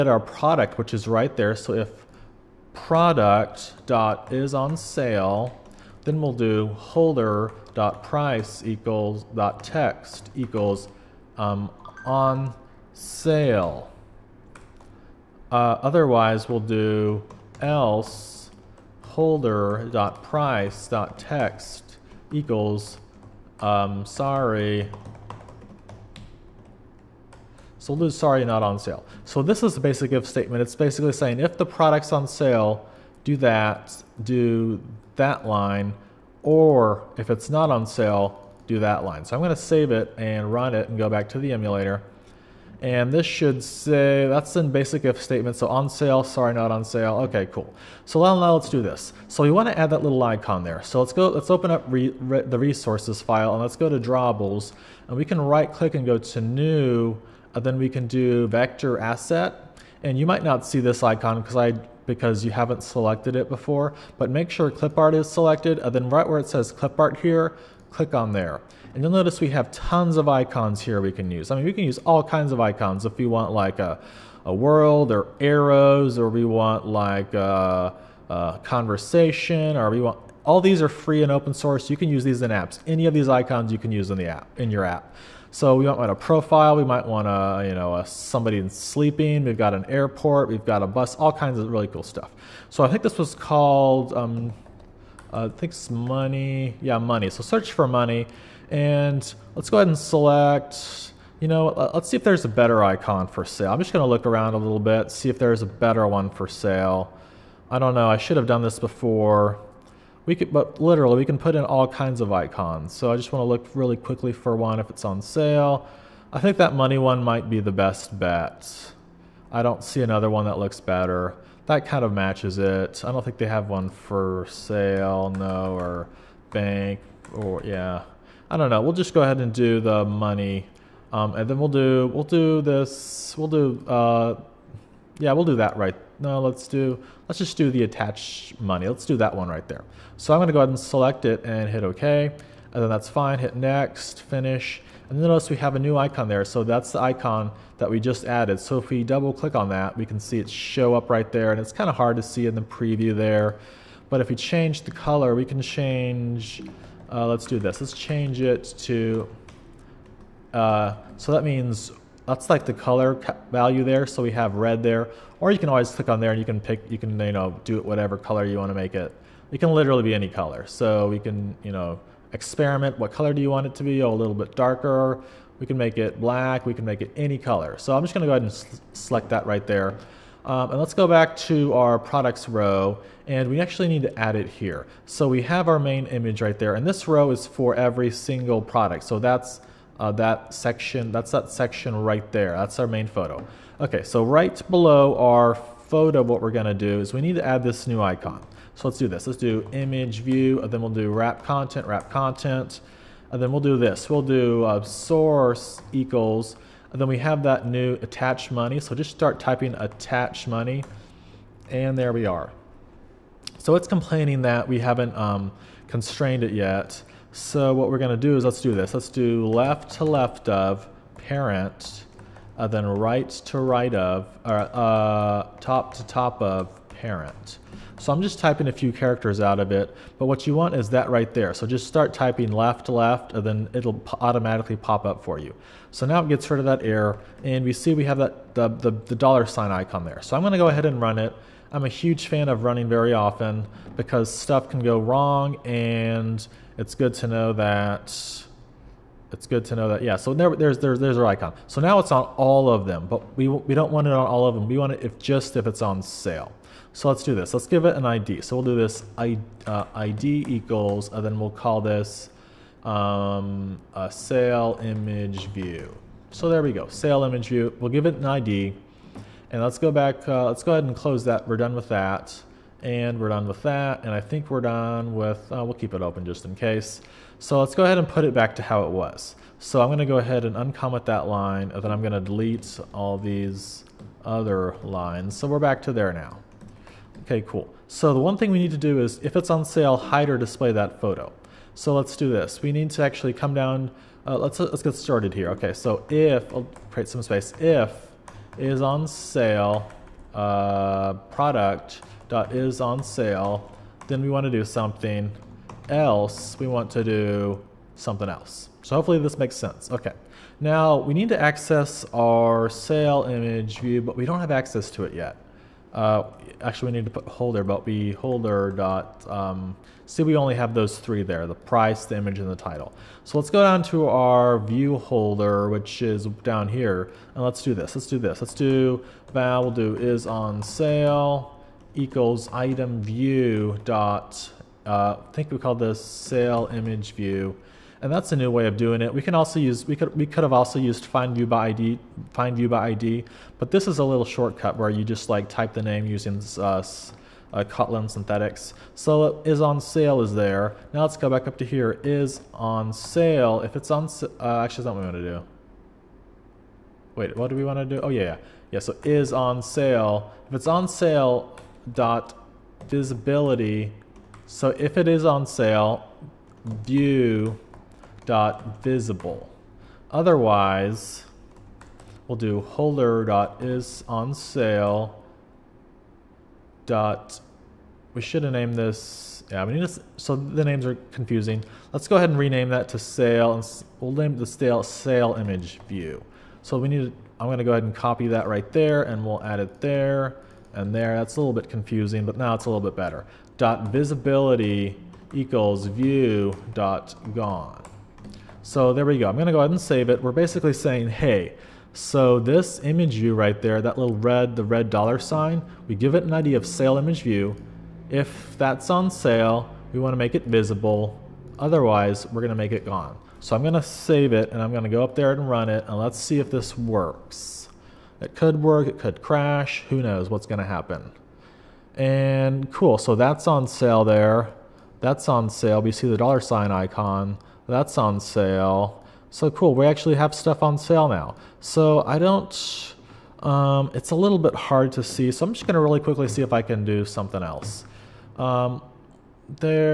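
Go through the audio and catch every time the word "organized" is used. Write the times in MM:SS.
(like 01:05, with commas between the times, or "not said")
not said.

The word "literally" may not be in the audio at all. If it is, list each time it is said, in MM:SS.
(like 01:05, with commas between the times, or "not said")
01:50, 02:49.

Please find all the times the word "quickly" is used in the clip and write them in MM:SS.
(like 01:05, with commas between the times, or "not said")
01:53, 07:15.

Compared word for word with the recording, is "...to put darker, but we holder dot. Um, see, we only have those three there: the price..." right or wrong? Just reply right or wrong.
wrong.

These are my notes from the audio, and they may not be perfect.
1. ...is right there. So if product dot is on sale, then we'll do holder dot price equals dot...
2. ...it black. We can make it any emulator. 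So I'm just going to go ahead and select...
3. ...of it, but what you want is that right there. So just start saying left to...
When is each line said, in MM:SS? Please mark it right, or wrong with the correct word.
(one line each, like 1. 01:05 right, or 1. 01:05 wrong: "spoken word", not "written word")
1. 00:00 right
2. 02:55 wrong: "color", not "emulator"
3. 03:49 wrong: "typing", not "saying".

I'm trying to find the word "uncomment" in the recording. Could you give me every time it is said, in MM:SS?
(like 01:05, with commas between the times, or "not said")
04:40.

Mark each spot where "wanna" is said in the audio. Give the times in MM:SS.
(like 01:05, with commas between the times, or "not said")
00:49, 01:53.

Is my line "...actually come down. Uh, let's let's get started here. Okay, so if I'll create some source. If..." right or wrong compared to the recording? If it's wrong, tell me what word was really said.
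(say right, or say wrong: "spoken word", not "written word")
wrong: "space", not "source".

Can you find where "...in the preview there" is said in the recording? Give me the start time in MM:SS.
02:32.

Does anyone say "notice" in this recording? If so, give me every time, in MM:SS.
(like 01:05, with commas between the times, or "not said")
01:09, 02:25.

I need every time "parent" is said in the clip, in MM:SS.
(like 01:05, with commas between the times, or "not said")
03:41, 03:46.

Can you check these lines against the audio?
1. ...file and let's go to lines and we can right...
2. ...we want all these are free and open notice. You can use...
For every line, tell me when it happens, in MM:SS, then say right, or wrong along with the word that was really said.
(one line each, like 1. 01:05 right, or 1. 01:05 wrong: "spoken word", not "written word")
1. 00:53 wrong: "drawables", not "lines"
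2. 01:19 wrong: "source", not "notice".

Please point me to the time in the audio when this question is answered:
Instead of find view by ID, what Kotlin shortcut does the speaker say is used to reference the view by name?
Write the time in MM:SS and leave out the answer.
05:47.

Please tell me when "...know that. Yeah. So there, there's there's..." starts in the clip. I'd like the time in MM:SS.
04:09.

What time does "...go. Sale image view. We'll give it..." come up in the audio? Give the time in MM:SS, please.
04:26.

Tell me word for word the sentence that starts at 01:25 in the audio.
So we might want a profile.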